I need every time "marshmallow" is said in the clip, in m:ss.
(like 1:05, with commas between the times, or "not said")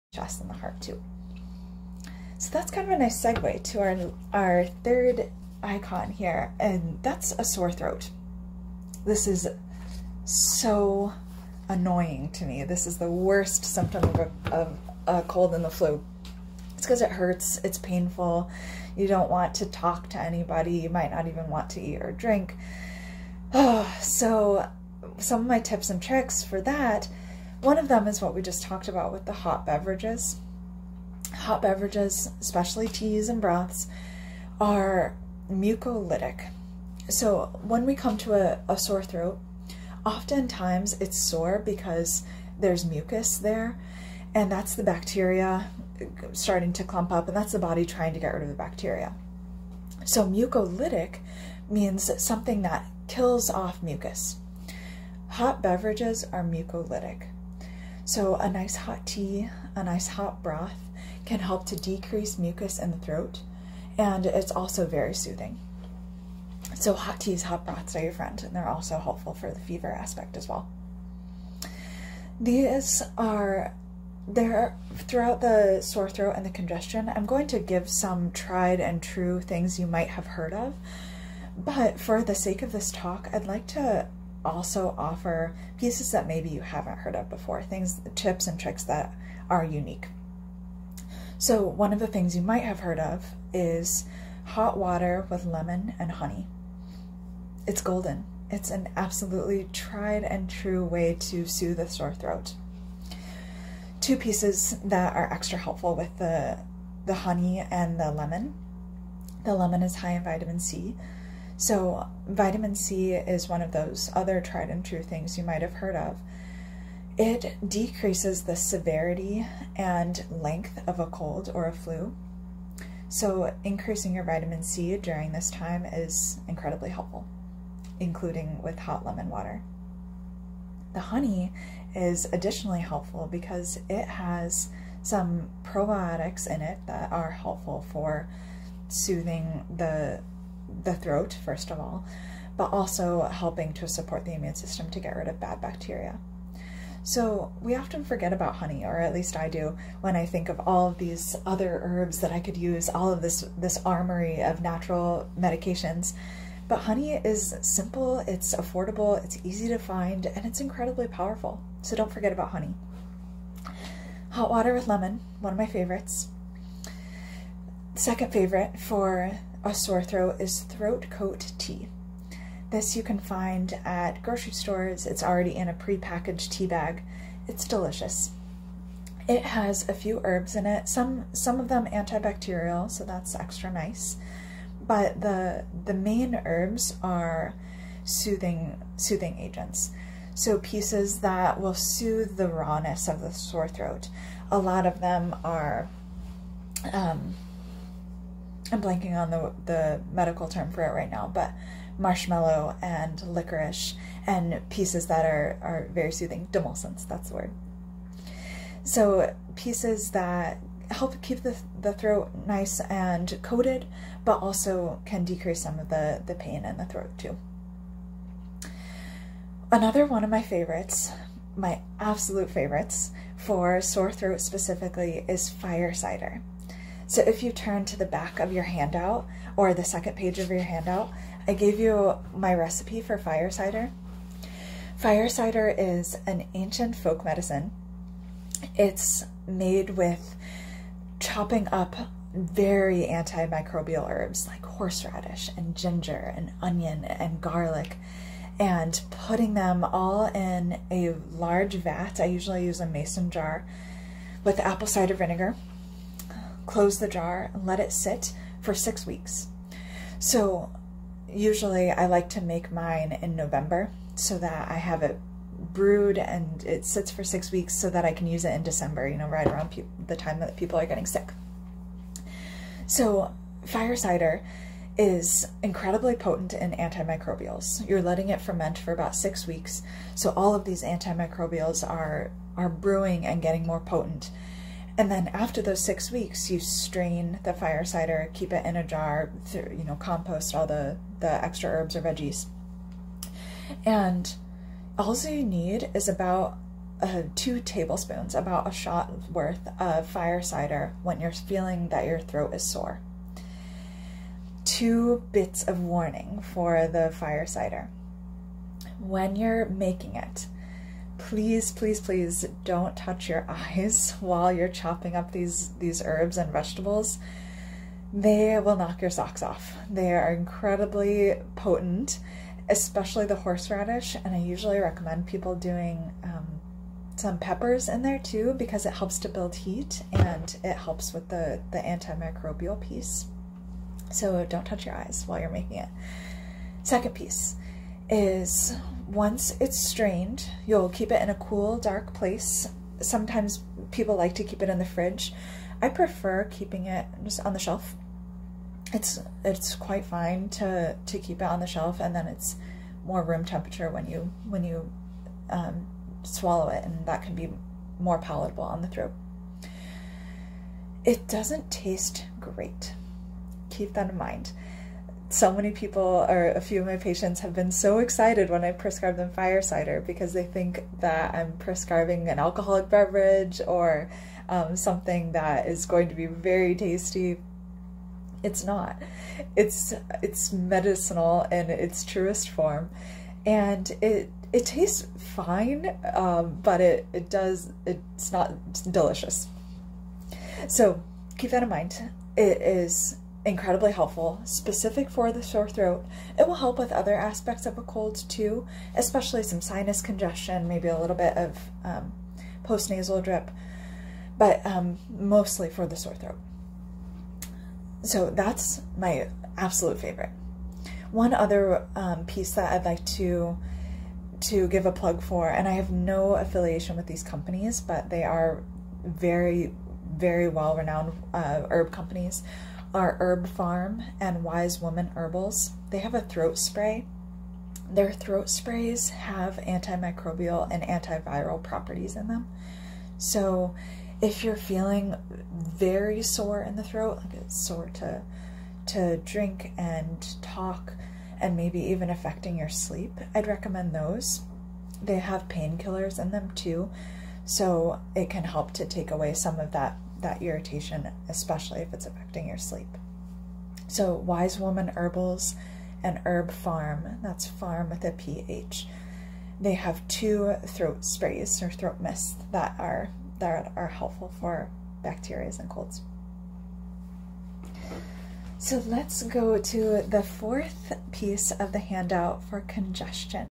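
3:21.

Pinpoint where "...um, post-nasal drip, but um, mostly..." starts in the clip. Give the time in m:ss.
6:41.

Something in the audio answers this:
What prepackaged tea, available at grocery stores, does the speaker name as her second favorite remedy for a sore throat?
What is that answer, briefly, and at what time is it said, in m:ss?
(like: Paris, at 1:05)
Throat coat tea, at 2:50.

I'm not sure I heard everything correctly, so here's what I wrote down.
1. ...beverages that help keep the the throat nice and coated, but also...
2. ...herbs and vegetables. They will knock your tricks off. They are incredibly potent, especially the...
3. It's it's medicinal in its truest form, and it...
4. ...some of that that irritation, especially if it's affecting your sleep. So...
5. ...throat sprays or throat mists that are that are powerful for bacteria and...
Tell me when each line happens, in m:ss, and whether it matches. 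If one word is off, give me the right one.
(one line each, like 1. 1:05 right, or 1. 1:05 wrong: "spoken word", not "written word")
1. 3:29 wrong: "pieces", not "beverages"
2. 5:16 wrong: "socks", not "tricks"
3. 6:19 right
4. 7:29 right
5. 7:40 wrong: "helpful", not "powerful".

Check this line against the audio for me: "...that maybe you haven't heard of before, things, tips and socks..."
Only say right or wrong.
wrong.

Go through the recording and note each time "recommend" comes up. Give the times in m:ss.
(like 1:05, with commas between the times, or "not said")
5:24, 7:23.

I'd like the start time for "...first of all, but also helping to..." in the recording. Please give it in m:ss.
2:21.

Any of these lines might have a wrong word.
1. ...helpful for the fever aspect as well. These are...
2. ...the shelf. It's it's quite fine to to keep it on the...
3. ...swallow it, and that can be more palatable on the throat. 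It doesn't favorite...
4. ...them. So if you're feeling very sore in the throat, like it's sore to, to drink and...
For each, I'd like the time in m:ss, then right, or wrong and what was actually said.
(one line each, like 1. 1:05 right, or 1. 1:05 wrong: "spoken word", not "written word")
1. 1:08 right
2. 5:47 right
3. 5:56 wrong: "taste", not "favorite"
4. 7:12 right.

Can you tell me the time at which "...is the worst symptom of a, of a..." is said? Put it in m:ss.
0:12.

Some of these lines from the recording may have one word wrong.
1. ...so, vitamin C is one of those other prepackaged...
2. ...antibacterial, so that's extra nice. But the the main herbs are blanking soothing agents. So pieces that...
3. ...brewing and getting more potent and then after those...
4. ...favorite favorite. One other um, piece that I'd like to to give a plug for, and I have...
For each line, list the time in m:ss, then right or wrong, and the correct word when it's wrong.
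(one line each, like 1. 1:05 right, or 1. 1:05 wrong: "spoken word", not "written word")
1. 1:51 wrong: "tried", not "prepackaged"
2. 3:01 wrong: "soothing", not "blanking"
3. 4:42 right
4. 6:49 wrong: "absolute", not "favorite".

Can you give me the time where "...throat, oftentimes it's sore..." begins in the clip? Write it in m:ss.
0:39.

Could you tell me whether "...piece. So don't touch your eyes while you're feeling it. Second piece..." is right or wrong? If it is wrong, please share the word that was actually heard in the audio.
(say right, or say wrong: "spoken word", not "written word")
wrong: "making", not "feeling".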